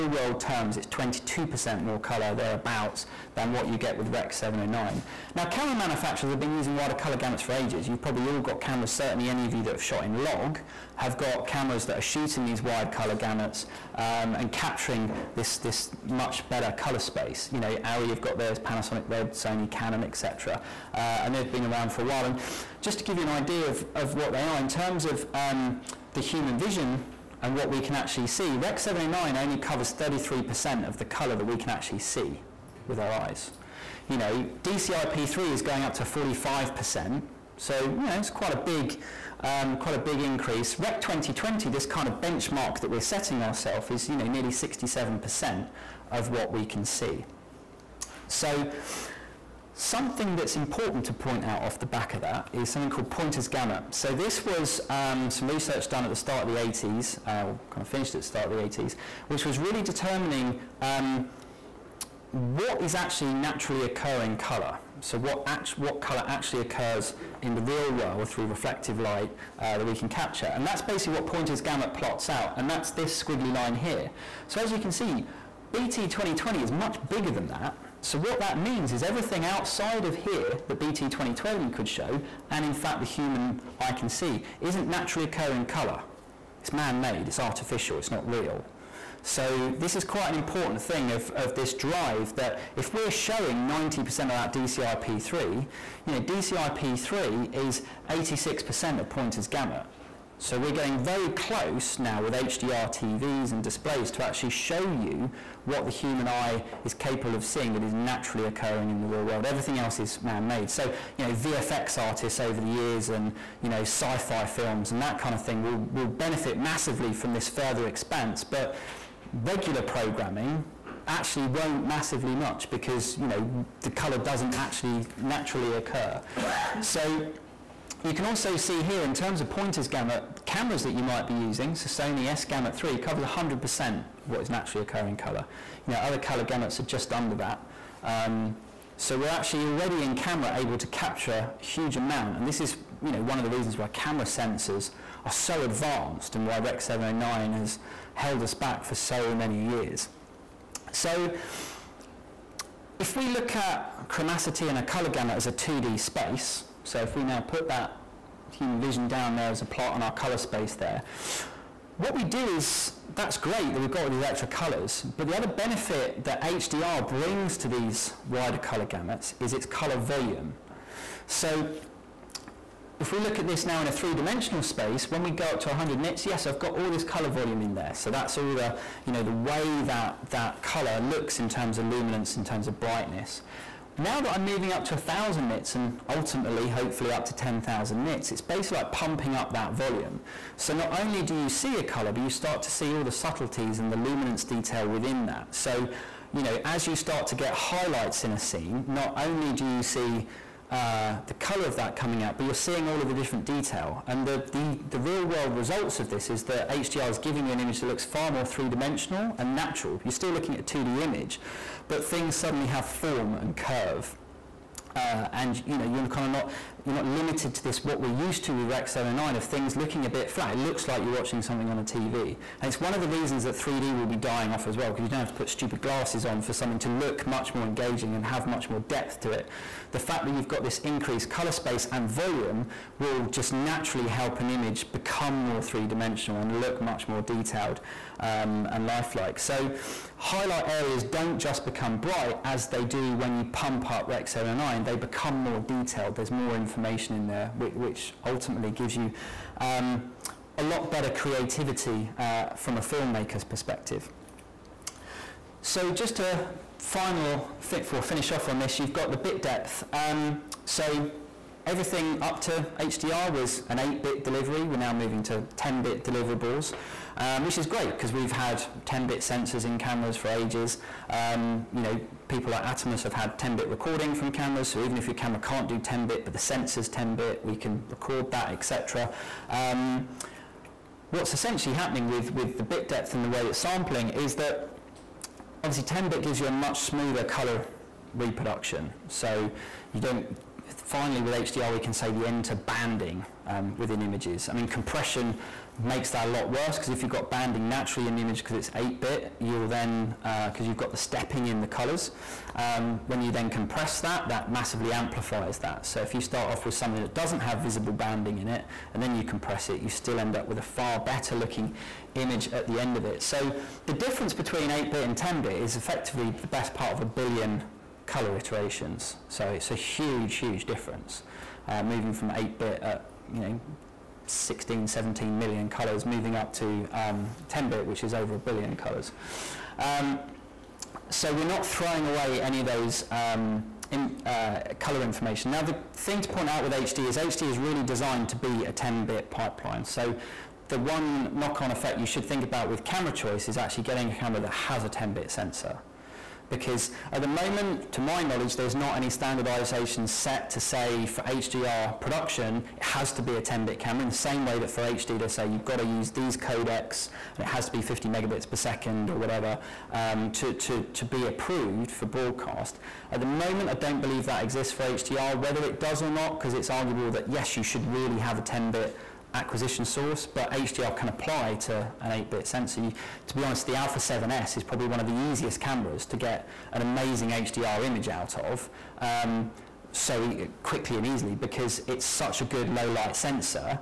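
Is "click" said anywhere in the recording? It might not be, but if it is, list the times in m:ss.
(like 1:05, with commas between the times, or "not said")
not said.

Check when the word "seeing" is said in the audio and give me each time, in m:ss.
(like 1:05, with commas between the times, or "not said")
1:47, 3:22.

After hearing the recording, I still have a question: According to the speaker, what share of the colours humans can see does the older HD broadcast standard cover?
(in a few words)
33%.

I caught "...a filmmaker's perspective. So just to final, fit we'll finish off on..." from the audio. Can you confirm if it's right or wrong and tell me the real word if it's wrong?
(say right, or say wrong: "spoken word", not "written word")
right.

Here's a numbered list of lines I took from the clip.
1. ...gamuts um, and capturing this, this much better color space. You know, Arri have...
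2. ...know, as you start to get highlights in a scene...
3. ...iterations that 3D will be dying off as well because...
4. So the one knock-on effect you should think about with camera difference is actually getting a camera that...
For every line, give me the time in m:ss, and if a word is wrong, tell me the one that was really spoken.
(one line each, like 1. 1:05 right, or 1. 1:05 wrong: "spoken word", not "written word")
1. 0:13 right
2. 3:16 right
3. 3:43 wrong: "reasons", not "iterations"
4. 5:39 wrong: "choice", not "difference".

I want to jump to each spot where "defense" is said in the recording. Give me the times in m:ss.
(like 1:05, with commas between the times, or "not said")
not said.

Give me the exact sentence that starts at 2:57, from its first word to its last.
So that's all the, you know, the way that that color looks in terms of luminance, in terms of brightness.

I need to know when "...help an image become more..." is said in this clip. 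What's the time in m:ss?
3:54.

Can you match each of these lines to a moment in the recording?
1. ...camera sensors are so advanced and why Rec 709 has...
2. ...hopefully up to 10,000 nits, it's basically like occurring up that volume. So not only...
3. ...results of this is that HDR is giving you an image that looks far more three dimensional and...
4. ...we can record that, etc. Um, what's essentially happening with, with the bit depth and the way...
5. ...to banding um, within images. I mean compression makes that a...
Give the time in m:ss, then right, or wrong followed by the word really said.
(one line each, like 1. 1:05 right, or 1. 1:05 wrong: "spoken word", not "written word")
1. 2:23 right
2. 3:06 wrong: "pumping", not "occurring"
3. 3:25 right
4. 4:37 right
5. 4:52 right.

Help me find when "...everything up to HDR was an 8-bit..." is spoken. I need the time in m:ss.
4:21.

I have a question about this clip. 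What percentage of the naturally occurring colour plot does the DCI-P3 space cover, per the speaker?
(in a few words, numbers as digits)
86%.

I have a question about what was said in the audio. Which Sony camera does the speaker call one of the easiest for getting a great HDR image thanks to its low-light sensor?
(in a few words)
Alpha 7S.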